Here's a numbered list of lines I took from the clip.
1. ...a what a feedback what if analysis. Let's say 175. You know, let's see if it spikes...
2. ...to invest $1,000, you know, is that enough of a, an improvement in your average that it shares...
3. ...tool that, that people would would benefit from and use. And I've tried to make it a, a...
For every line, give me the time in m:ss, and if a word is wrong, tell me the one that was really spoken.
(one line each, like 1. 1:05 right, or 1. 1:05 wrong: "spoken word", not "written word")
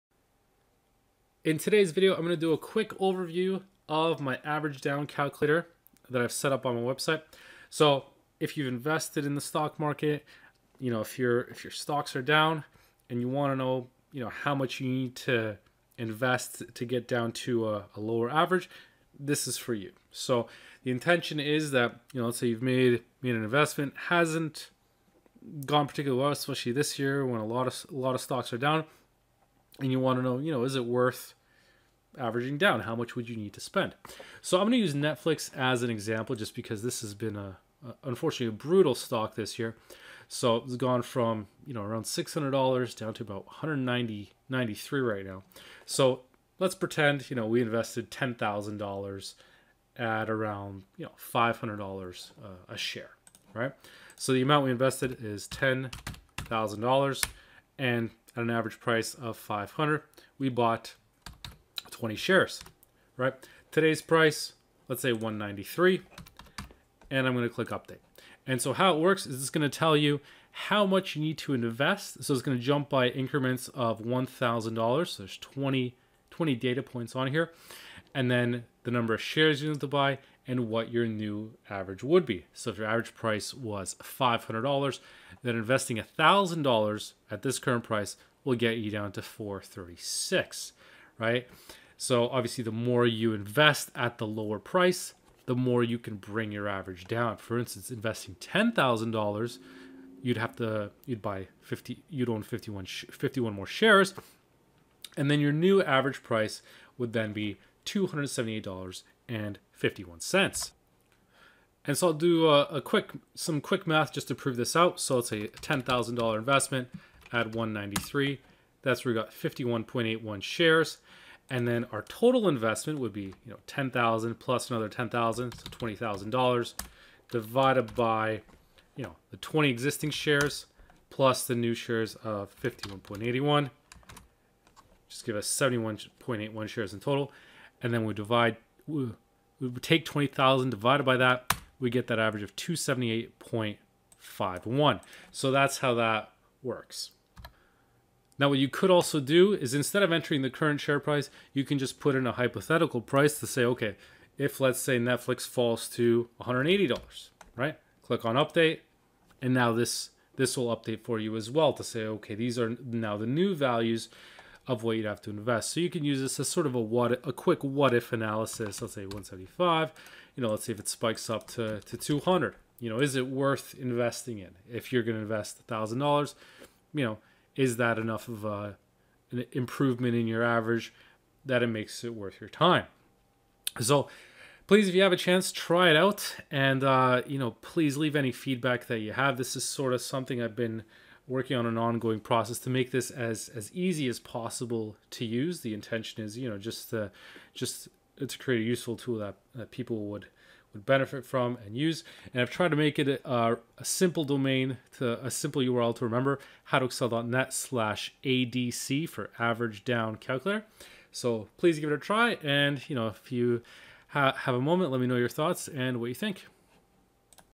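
1. 2:46 wrong: "quick", not "feedback"
2. 2:55 wrong: "makes", not "shares"
3. 3:18 right.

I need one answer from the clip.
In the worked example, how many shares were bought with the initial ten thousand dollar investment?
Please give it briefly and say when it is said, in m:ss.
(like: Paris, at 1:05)
20, at 1:01.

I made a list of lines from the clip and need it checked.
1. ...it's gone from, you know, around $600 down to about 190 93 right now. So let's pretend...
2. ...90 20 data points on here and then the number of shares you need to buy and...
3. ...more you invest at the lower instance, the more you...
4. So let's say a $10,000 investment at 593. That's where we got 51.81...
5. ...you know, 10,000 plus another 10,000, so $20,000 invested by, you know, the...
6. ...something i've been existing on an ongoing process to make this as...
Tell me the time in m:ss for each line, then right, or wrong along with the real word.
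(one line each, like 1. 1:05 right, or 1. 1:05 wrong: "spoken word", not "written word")
1. 0:40 right
2. 1:15 wrong: "20", not "90"
3. 1:32 wrong: "price", not "instance"
4. 1:54 wrong: "193", not "593"
5. 2:03 wrong: "divided", not "invested"
6. 3:10 wrong: "working", not "existing".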